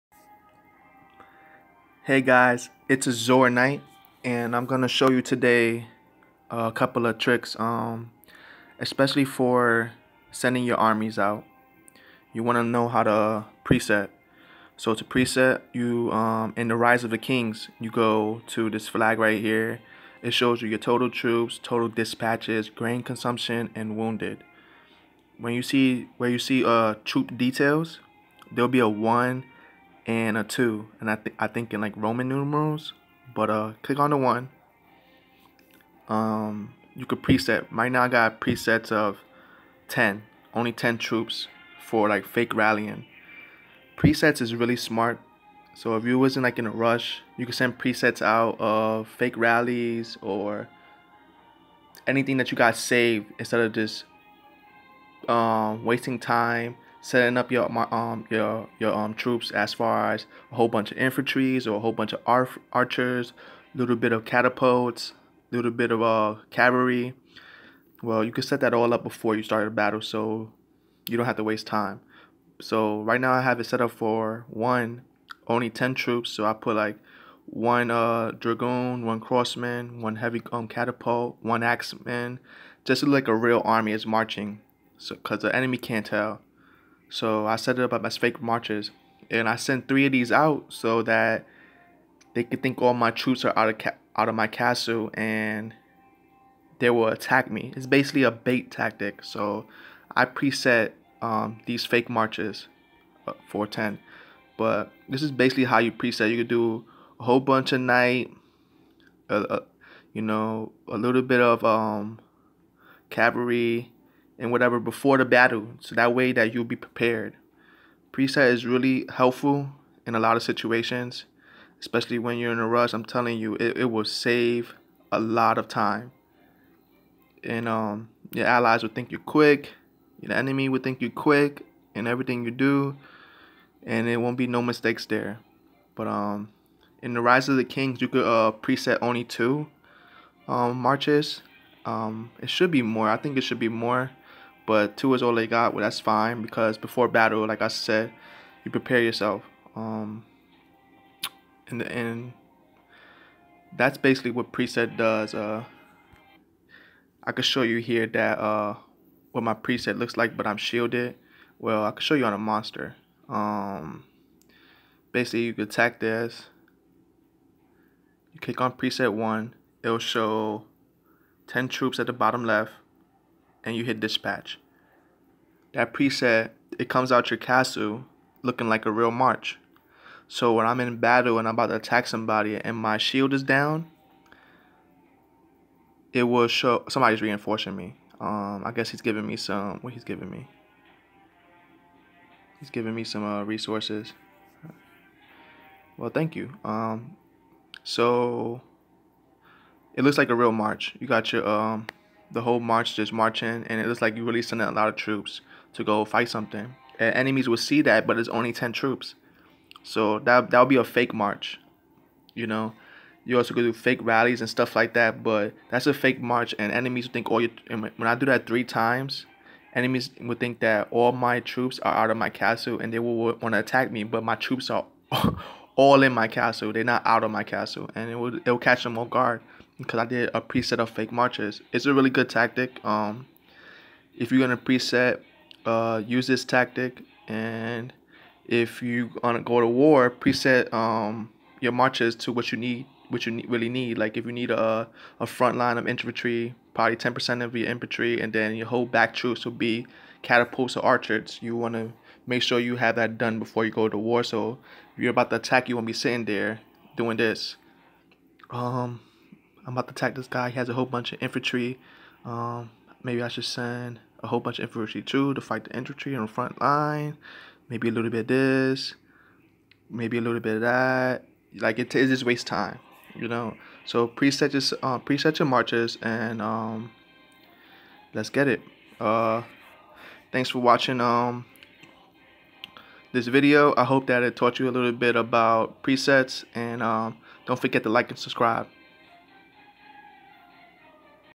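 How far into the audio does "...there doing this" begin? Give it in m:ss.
4:16.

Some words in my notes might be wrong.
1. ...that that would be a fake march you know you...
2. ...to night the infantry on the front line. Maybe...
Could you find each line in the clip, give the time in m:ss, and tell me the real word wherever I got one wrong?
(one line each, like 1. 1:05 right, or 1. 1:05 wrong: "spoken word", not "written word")
1. 3:30 right
2. 4:25 wrong: "fight", not "night".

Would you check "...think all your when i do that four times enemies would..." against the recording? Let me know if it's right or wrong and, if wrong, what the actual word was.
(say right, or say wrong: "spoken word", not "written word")
wrong: "three", not "four".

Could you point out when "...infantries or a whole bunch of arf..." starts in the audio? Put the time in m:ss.
1:00.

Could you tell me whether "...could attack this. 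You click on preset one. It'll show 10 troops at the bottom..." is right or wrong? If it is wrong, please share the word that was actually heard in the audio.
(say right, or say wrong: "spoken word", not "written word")
right.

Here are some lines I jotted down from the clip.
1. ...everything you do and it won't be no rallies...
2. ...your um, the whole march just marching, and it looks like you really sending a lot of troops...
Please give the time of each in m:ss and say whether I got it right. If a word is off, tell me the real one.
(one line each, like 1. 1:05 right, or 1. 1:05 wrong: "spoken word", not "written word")
1. 2:12 wrong: "mistakes", not "rallies"
2. 3:21 right.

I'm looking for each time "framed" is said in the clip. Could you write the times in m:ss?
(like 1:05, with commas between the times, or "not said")
not said.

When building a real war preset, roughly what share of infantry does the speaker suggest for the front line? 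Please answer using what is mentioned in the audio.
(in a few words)
10 percent.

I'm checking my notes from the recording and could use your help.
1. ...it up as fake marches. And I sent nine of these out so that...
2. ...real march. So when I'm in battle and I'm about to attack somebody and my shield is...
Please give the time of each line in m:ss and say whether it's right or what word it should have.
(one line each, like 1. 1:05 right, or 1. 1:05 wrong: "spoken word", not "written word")
1. 1:27 wrong: "three", not "nine"
2. 2:58 right.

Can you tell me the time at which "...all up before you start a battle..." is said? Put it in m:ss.
1:08.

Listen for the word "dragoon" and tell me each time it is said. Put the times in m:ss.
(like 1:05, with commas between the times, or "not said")
1:18.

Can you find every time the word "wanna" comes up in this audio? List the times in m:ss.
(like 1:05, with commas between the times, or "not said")
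0:12, 4:11.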